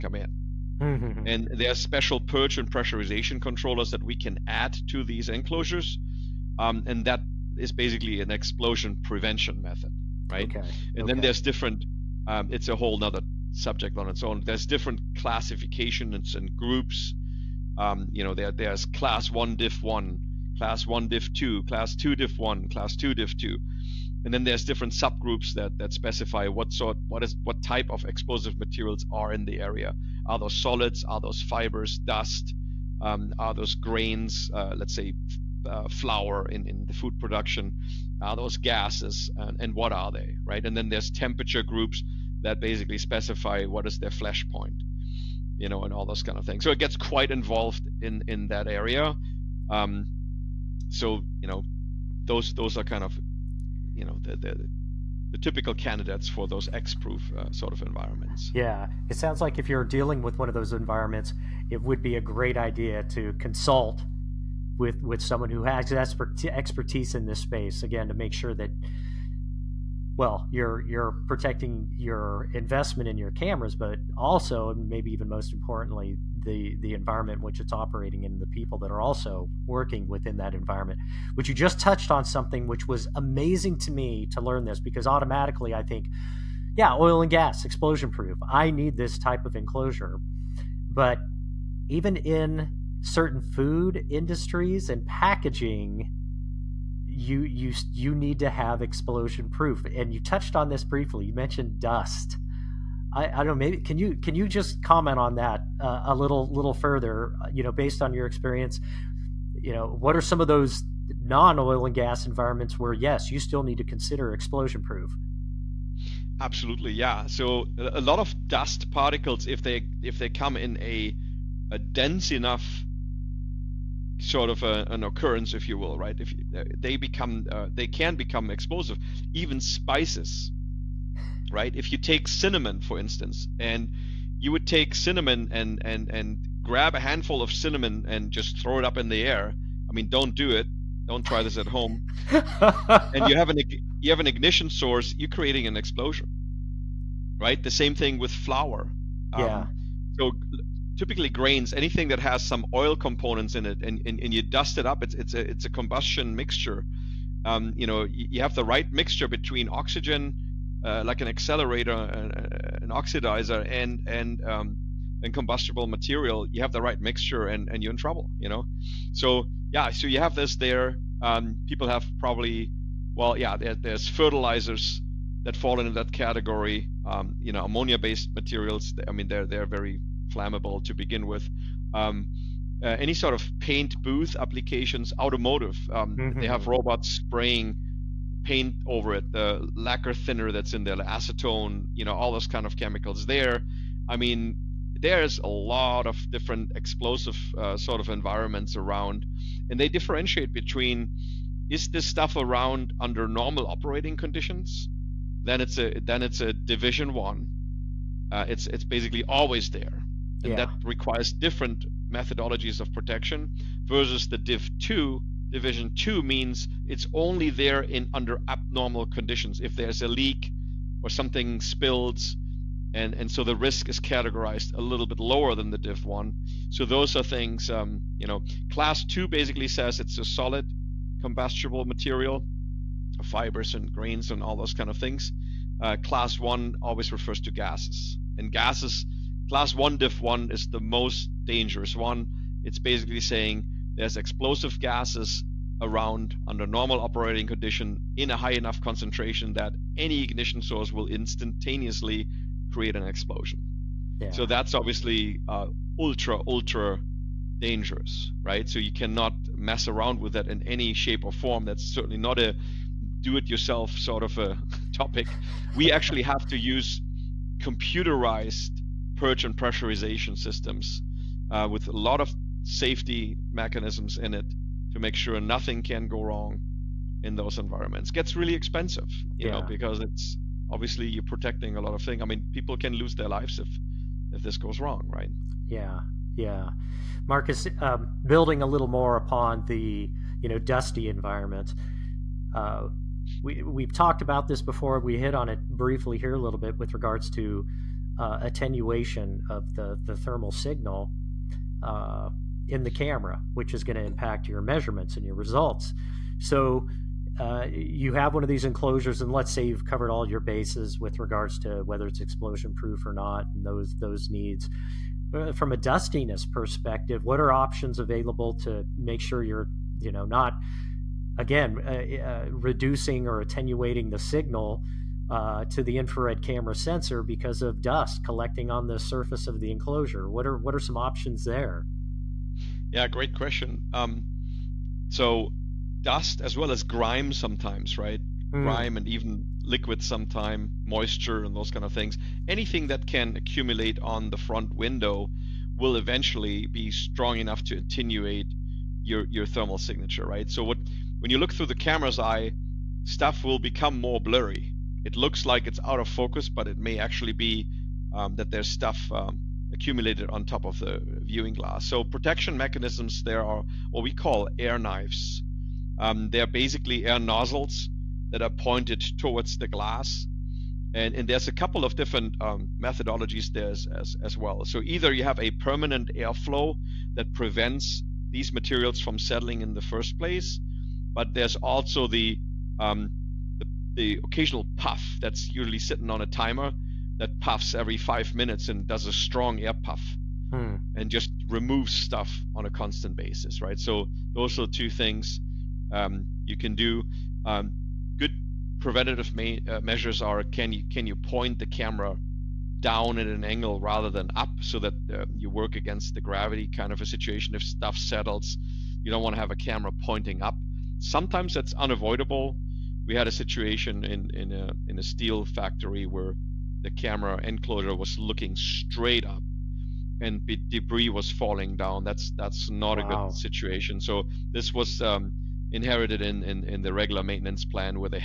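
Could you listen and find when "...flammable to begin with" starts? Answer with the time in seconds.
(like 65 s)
180 s.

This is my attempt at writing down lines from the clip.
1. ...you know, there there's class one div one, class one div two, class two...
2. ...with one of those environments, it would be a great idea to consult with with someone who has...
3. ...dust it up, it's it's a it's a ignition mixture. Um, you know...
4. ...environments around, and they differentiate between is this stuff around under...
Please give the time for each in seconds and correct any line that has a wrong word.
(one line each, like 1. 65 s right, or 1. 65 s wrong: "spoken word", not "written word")
1. 18 s right
2. 60 s right
3. 154 s wrong: "combustion", not "ignition"
4. 198 s right.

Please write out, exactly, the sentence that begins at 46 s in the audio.
So it gets quite involved in in that area.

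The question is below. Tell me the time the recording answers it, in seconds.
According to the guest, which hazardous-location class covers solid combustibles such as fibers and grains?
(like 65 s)
228 s.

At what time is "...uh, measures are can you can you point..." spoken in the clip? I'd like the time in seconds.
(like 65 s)
399 s.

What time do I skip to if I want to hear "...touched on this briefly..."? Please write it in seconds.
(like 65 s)
100 s.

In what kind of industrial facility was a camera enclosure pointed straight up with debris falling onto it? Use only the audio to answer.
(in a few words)
Steel factory.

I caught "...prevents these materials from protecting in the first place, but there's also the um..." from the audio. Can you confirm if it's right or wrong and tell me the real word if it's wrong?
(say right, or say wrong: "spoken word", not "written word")
wrong: "settling", not "protecting".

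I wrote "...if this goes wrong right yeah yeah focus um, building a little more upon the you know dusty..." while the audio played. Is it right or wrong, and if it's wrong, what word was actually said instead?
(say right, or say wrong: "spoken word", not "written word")
wrong: "markus", not "focus".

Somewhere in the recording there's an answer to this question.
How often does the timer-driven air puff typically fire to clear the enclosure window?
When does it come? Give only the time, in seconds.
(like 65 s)
387 s.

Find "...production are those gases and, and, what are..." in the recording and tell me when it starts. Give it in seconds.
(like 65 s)
37 s.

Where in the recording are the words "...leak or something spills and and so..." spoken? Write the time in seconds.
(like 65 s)
220 s.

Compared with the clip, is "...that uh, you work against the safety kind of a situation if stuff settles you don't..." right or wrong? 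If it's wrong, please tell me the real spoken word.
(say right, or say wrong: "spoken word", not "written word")
wrong: "gravity", not "safety".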